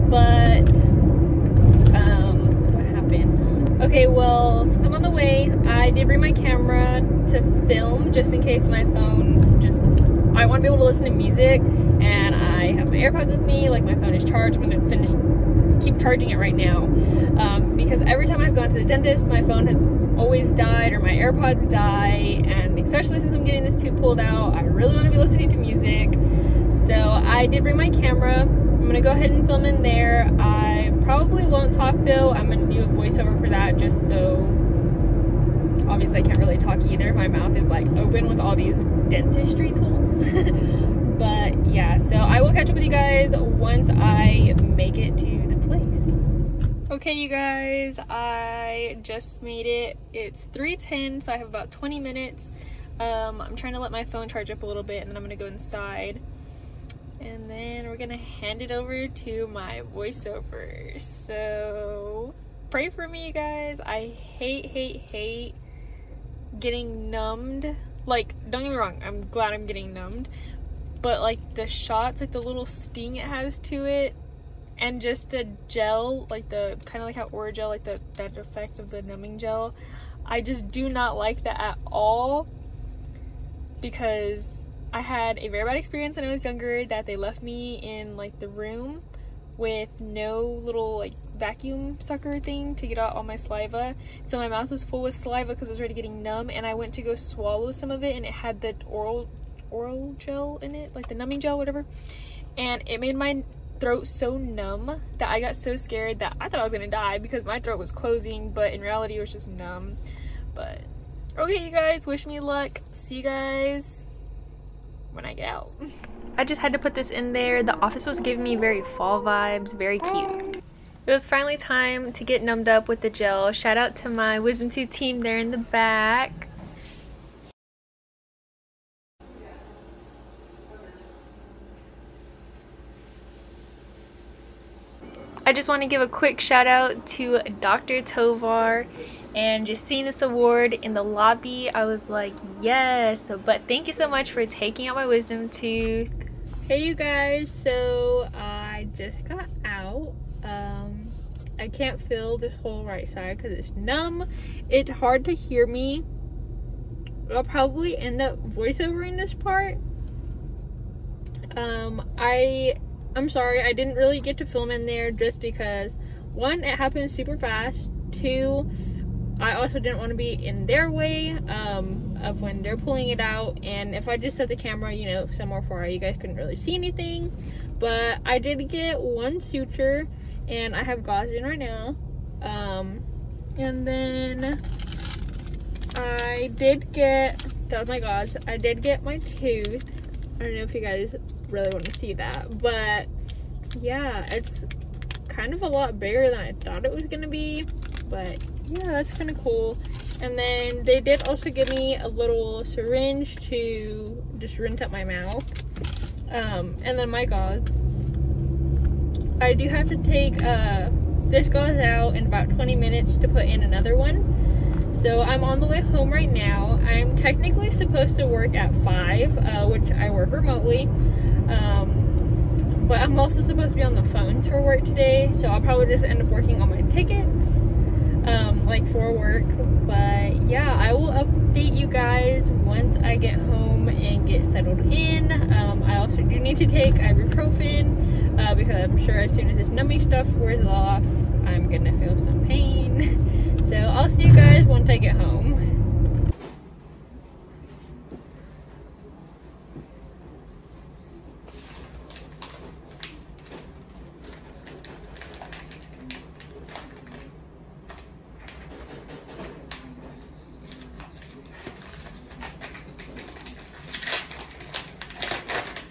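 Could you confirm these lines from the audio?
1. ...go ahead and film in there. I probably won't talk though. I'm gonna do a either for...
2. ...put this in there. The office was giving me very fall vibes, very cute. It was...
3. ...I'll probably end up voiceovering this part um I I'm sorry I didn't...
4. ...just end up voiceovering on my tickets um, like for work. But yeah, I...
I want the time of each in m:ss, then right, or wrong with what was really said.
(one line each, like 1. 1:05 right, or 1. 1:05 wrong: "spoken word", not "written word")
1. 0:29 wrong: "voiceover", not "either"
2. 1:56 right
3. 2:37 right
4. 3:45 wrong: "working", not "voiceovering".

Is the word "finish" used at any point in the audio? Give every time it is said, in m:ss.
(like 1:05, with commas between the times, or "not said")
0:14.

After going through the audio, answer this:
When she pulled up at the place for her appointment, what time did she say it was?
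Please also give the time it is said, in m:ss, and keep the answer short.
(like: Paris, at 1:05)
3:10, at 0:50.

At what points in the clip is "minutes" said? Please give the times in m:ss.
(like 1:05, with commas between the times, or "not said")
0:51, 3:32.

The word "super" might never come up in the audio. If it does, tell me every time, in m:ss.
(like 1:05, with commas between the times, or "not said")
2:47.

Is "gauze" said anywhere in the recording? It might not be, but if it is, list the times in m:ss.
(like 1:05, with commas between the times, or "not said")
3:01, 3:07, 3:27, 3:31.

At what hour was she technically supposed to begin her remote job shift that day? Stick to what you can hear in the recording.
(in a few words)
5.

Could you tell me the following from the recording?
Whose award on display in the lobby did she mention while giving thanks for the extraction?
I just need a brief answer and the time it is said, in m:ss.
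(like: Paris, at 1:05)
Dr. Tovar, at 2:17.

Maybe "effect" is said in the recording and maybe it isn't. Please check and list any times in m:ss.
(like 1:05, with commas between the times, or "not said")
1:18.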